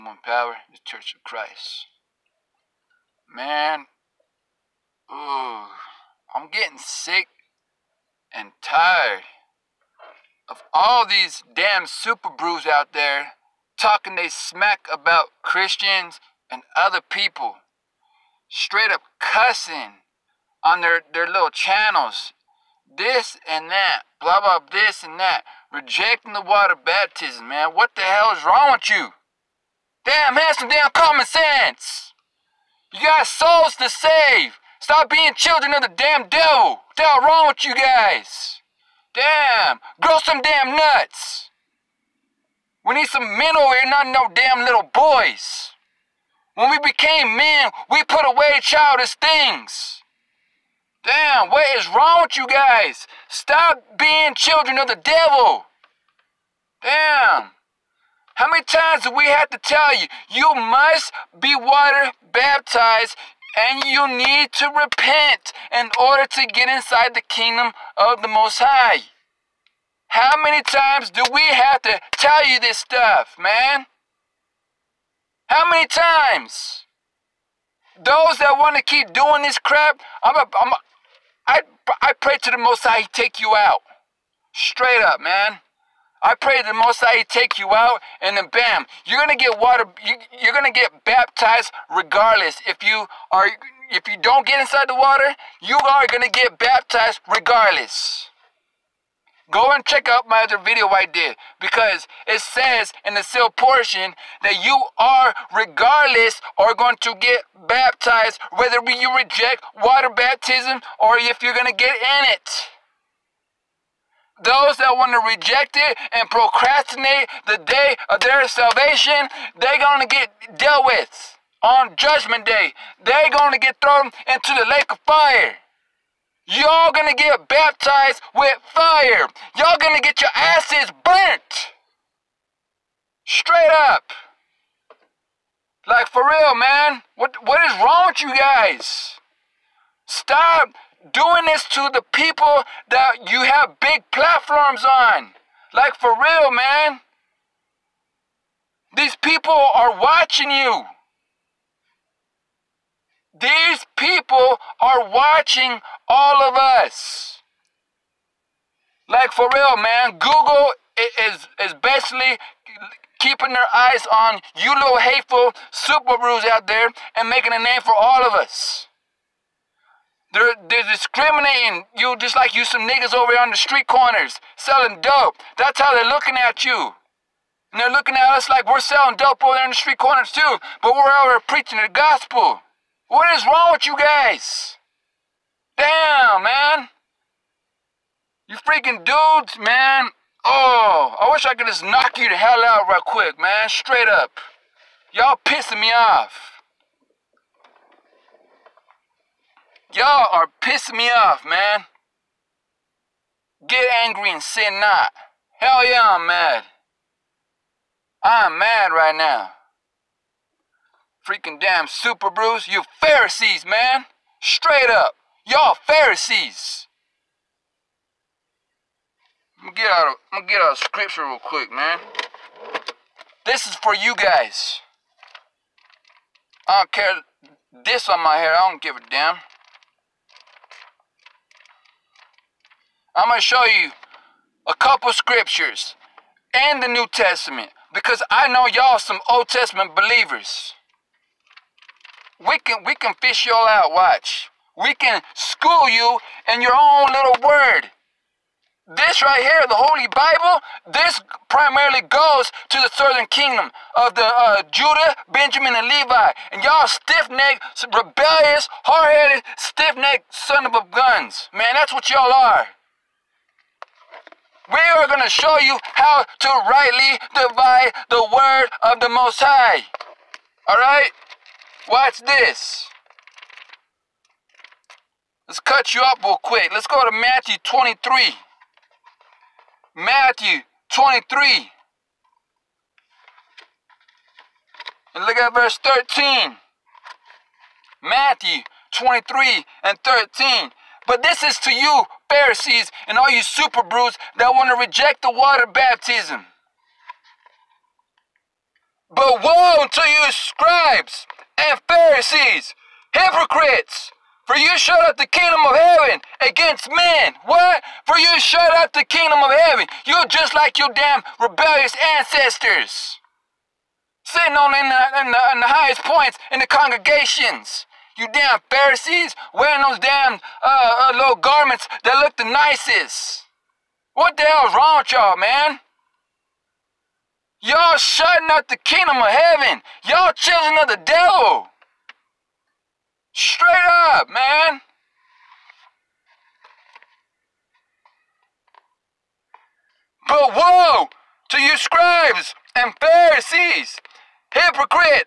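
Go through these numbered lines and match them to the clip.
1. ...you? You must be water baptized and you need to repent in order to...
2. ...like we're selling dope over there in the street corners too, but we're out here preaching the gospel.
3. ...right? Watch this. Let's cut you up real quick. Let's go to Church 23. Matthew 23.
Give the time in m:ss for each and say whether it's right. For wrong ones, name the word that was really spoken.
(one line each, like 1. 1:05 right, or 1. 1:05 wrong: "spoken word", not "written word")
1. 0:59 right
2. 2:58 right
3. 4:30 wrong: "Matthew", not "Church".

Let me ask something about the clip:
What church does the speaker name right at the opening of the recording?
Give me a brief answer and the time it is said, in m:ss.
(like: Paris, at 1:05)
the Church of Christ, at 0:00.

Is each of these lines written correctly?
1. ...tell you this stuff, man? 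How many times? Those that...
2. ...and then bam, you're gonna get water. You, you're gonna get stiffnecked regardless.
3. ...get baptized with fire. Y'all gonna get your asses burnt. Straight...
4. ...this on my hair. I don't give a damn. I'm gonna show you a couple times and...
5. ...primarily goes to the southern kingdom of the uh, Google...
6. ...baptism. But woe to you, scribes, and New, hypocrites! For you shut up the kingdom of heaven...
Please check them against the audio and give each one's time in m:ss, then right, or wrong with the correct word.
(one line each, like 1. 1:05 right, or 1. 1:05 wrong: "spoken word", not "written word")
1. 1:12 right
2. 1:28 wrong: "baptized", not "stiffnecked"
3. 2:07 right
4. 3:47 wrong: "scriptures", not "times"
5. 4:11 wrong: "Judah", not "Google"
6. 4:55 wrong: "Pharisees", not "New".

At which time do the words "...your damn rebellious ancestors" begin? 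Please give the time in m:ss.
5:10.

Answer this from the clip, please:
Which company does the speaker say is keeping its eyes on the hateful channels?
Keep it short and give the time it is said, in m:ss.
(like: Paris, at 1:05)
Google, at 2:40.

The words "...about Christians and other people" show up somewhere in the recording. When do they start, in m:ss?
0:14.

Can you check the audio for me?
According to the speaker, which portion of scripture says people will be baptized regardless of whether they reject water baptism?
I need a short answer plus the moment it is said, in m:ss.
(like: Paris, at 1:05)
the sealed portion, at 1:43.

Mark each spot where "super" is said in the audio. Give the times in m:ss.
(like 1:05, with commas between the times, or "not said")
0:11, 2:45, 3:31, 4:53.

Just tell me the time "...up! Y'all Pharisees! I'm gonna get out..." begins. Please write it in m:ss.
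3:34.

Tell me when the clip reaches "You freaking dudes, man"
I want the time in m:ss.
3:08.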